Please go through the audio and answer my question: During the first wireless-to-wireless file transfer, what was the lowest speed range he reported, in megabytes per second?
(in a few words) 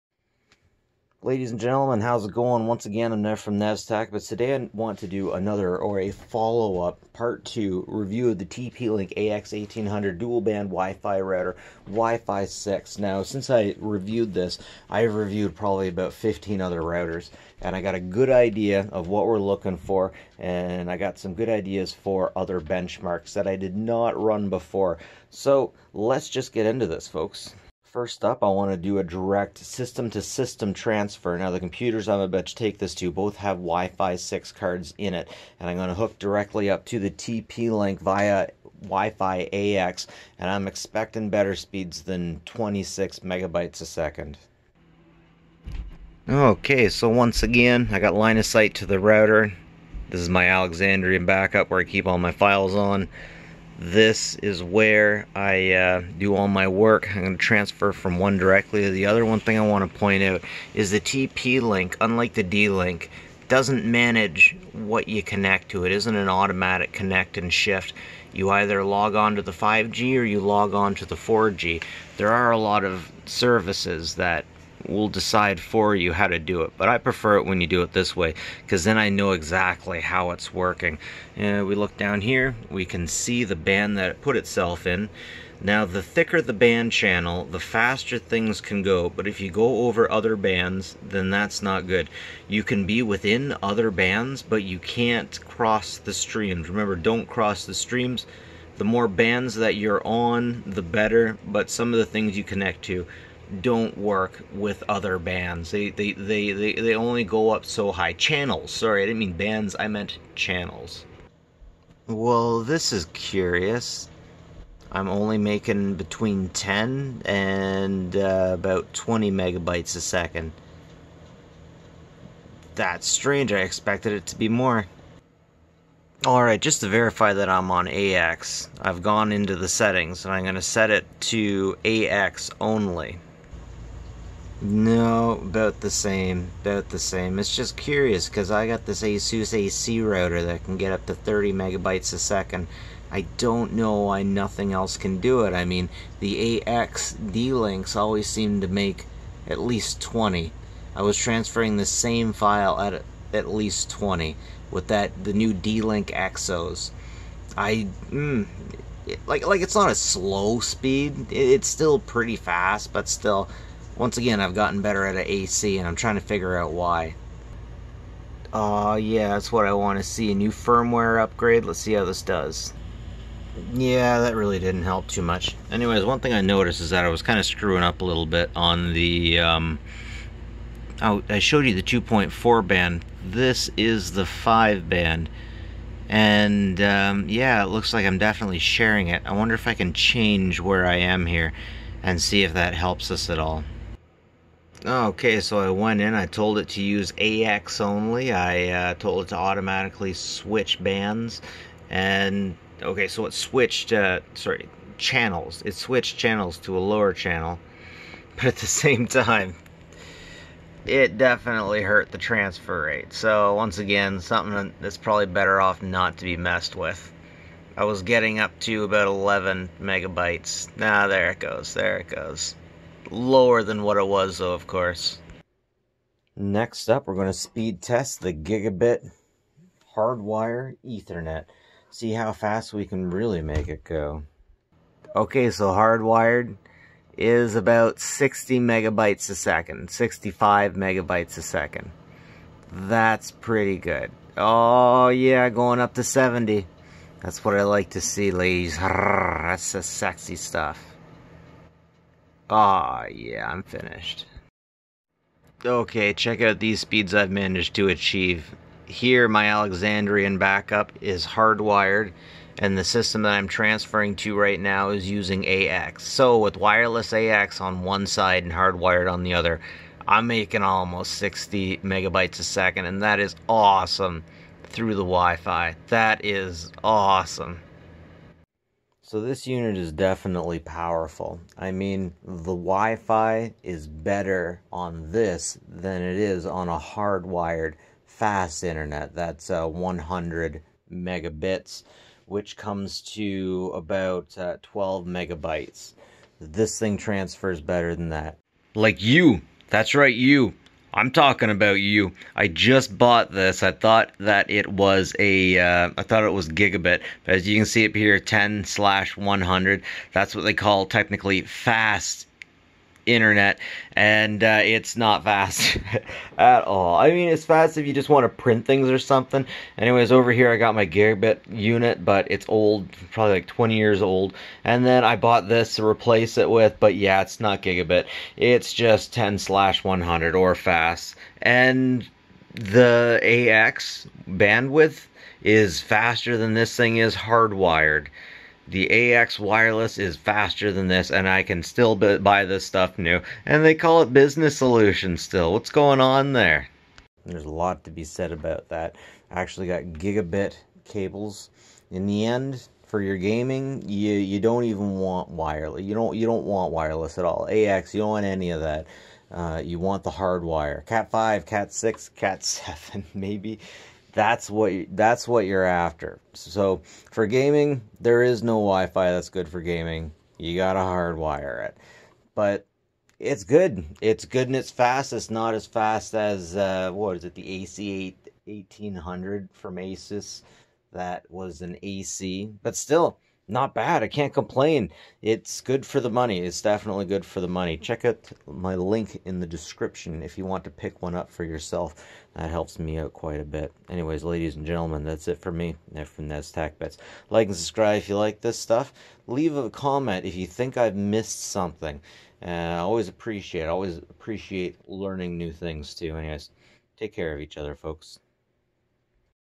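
10.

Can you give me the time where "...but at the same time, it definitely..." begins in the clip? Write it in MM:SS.
03:28.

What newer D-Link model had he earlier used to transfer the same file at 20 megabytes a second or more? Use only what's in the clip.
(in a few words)
Exos.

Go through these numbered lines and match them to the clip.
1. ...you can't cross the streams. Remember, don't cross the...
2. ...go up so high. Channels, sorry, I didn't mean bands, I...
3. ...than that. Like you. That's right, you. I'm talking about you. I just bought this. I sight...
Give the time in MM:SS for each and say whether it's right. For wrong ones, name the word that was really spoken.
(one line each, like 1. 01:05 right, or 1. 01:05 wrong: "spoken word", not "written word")
1. 01:34 right
2. 01:47 right
3. 04:57 wrong: "thought", not "sight".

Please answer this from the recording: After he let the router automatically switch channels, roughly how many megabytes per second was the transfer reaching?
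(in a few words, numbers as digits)
11.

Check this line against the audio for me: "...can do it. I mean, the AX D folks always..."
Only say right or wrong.
wrong.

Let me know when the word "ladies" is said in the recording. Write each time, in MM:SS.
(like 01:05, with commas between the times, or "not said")
00:01, 04:08, 06:34.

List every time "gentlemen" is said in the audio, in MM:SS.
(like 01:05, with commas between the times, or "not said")
00:01, 06:34.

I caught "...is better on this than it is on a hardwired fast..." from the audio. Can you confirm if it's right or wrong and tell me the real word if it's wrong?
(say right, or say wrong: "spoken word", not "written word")
right.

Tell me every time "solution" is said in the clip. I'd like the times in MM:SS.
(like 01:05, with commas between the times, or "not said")
05:44.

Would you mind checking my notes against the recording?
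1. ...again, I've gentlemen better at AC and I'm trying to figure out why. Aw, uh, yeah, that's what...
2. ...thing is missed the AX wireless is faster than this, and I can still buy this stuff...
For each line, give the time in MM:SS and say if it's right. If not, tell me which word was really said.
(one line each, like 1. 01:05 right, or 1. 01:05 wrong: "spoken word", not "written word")
1. 02:44 wrong: "gotten", not "gentlemen"
2. 05:36 wrong: "hardwired", not "missed".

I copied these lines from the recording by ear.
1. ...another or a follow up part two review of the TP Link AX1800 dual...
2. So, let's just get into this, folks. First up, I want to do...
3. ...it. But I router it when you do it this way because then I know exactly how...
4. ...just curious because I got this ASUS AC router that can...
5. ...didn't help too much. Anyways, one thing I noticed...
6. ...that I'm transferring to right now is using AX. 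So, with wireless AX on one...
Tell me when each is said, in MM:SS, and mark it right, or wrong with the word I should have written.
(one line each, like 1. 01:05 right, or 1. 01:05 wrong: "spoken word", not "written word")
1. 00:05 right
2. 00:25 right
3. 01:16 wrong: "prefer", not "router"
4. 02:17 right
5. 02:54 right
6. 04:23 right.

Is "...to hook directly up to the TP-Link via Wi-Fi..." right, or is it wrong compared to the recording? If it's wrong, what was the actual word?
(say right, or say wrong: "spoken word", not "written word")
right.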